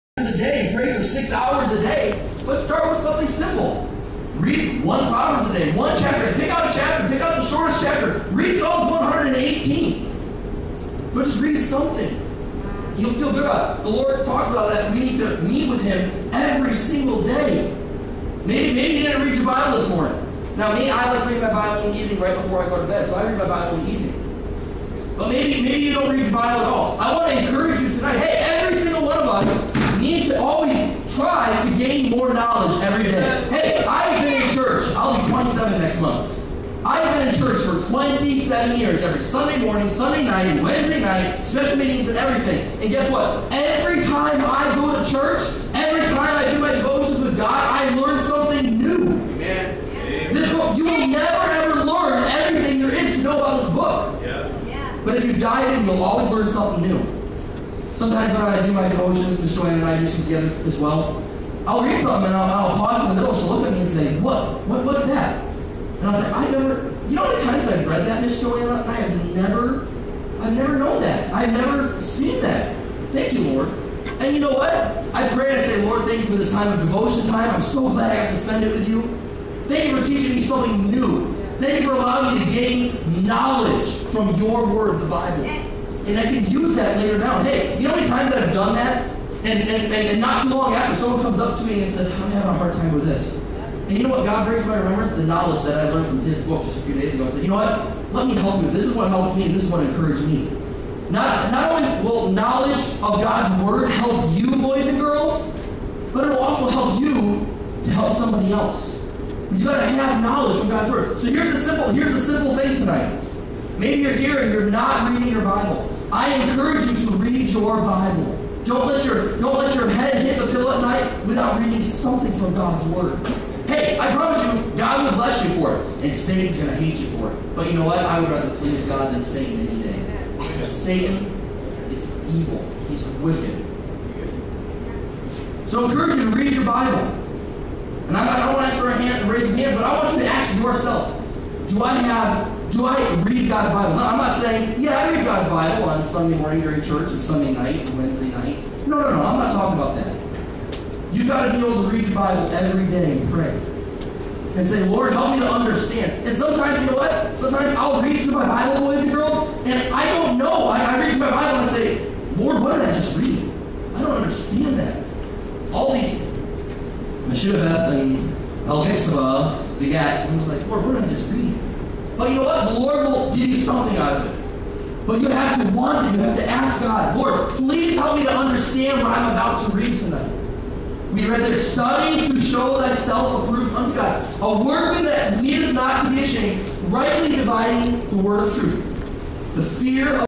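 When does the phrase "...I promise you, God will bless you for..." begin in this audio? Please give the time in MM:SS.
02:03.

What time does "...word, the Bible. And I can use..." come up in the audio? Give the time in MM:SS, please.
01:24.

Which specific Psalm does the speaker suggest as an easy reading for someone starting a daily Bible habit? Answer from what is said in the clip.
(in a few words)
Psalm 118.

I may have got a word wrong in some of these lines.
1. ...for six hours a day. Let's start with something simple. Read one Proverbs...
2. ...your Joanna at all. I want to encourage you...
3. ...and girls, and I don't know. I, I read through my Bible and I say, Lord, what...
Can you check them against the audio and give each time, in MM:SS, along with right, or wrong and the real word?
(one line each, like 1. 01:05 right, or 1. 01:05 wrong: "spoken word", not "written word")
1. 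00:00 right
2. 00:26 wrong: "Bible", not "Joanna"
3. 02:39 right.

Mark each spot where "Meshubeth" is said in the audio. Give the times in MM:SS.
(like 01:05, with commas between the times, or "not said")
02:47.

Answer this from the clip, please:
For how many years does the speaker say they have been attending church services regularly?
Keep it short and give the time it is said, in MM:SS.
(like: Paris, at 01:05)
27, at 00:37.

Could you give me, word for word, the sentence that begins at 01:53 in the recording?
Maybe you're here and you're not reading your Bible.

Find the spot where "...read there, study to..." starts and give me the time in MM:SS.
03:01.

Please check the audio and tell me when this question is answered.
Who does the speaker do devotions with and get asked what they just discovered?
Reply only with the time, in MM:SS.
00:59.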